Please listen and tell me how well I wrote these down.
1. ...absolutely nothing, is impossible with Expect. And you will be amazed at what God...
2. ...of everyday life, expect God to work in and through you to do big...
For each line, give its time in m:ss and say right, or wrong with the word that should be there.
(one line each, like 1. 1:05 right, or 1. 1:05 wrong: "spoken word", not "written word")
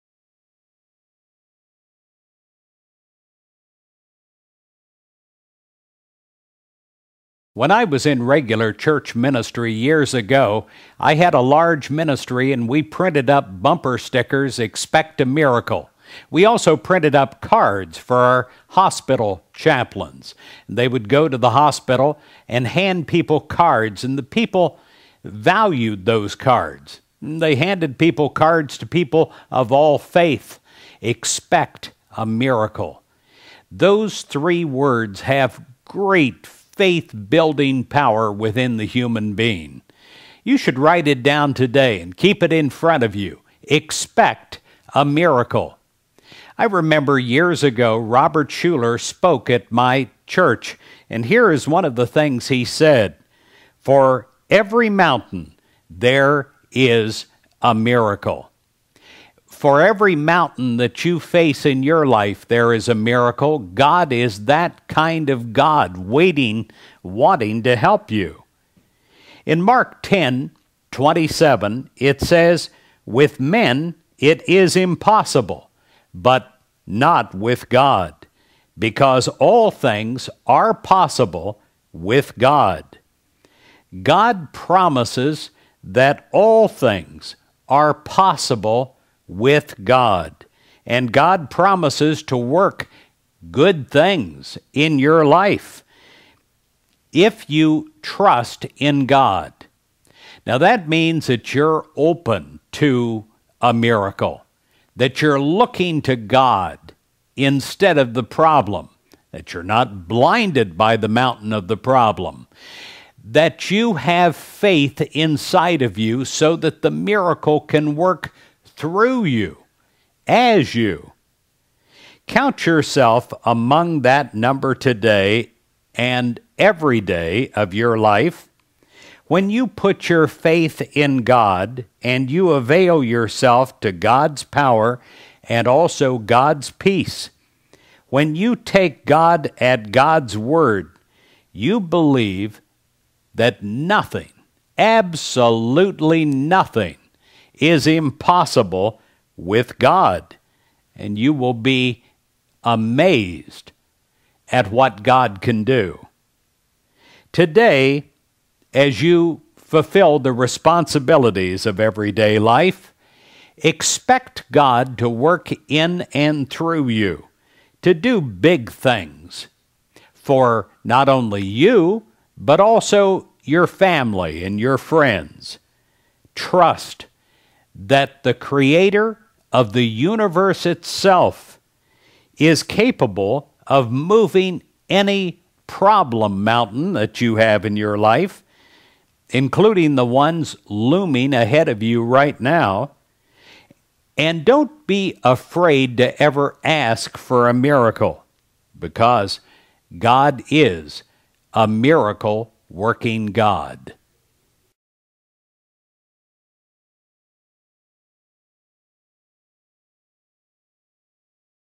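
1. 2:24 wrong: "God", not "Expect"
2. 2:41 right.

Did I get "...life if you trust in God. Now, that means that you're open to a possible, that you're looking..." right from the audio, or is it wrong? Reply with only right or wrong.
wrong.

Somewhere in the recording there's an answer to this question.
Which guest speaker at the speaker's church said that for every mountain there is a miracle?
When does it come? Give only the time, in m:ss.
0:47.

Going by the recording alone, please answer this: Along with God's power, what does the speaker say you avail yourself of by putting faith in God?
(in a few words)
God's peace.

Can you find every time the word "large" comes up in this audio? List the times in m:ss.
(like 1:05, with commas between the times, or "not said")
0:11.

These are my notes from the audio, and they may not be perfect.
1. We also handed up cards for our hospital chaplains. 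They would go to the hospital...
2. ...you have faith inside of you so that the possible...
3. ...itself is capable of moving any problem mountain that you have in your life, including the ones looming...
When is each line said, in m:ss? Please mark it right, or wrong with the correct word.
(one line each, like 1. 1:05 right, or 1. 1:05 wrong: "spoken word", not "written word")
1. 0:16 wrong: "printed", not "handed"
2. 1:53 wrong: "miracle", not "possible"
3. 3:00 right.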